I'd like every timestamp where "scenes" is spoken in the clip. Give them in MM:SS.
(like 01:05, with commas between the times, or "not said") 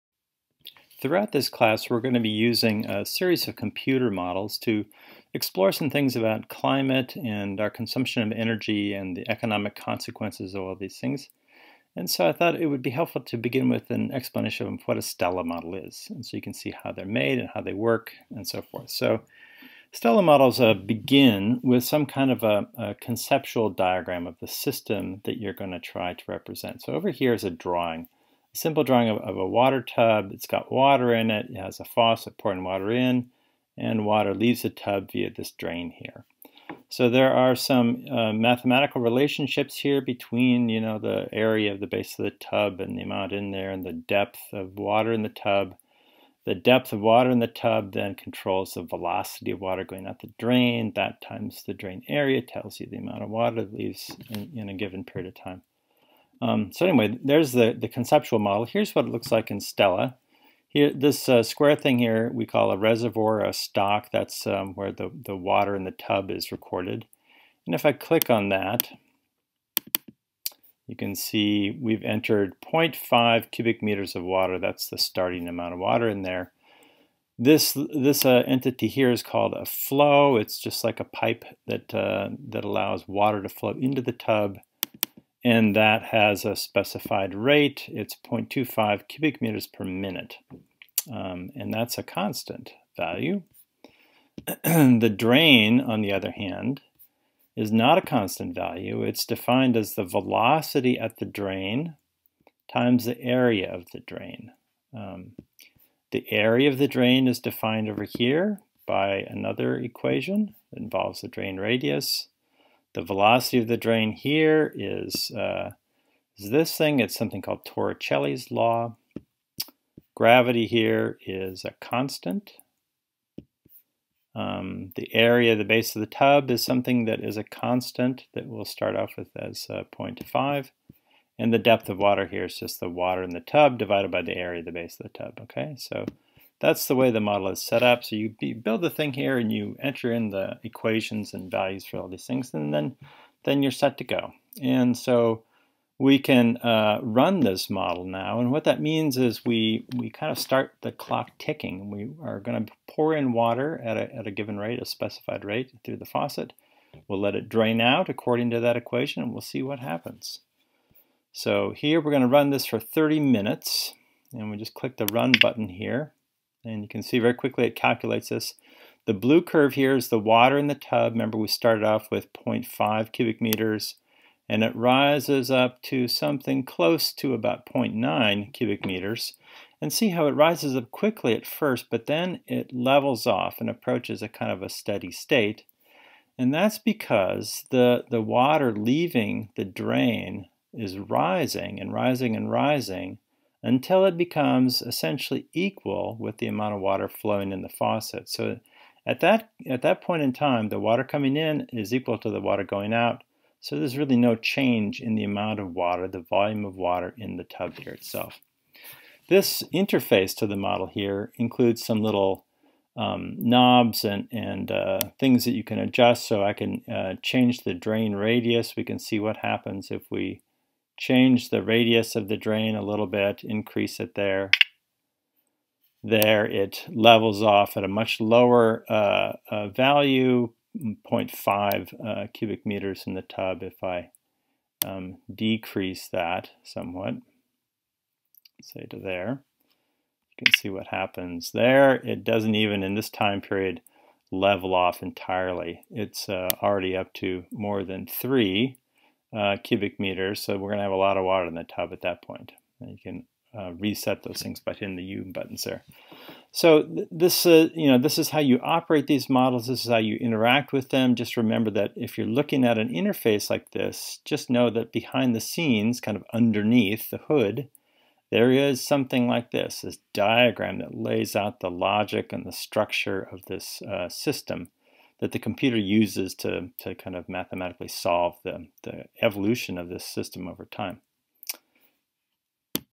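04:25.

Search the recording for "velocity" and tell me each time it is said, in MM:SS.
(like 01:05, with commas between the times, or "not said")
00:48, 01:40, 01:53.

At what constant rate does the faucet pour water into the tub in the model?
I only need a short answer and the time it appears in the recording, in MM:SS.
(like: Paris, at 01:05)
0.25 cubic meters per minute, at 01:28.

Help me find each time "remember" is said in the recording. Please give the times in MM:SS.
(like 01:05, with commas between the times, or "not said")
02:51, 04:21.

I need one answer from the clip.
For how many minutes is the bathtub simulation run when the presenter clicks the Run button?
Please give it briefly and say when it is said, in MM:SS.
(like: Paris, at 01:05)
30, at 02:42.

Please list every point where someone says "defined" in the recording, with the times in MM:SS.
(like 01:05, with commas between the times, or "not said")
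01:39, 01:47.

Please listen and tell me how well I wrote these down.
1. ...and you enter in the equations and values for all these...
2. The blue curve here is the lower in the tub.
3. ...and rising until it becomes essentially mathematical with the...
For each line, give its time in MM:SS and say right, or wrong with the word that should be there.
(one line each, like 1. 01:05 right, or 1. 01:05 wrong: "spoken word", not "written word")
1. 02:19 right
2. 02:49 wrong: "water", not "lower"
3. 03:12 wrong: "equal", not "mathematical".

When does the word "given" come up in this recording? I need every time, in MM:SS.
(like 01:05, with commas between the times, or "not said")
00:54, 02:34.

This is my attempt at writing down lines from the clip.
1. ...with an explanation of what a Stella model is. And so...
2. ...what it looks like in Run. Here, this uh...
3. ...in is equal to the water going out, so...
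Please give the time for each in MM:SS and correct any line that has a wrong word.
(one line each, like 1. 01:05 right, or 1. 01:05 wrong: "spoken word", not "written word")
1. 00:13 right
2. 00:58 wrong: "Stella", not "Run"
3. 03:21 right.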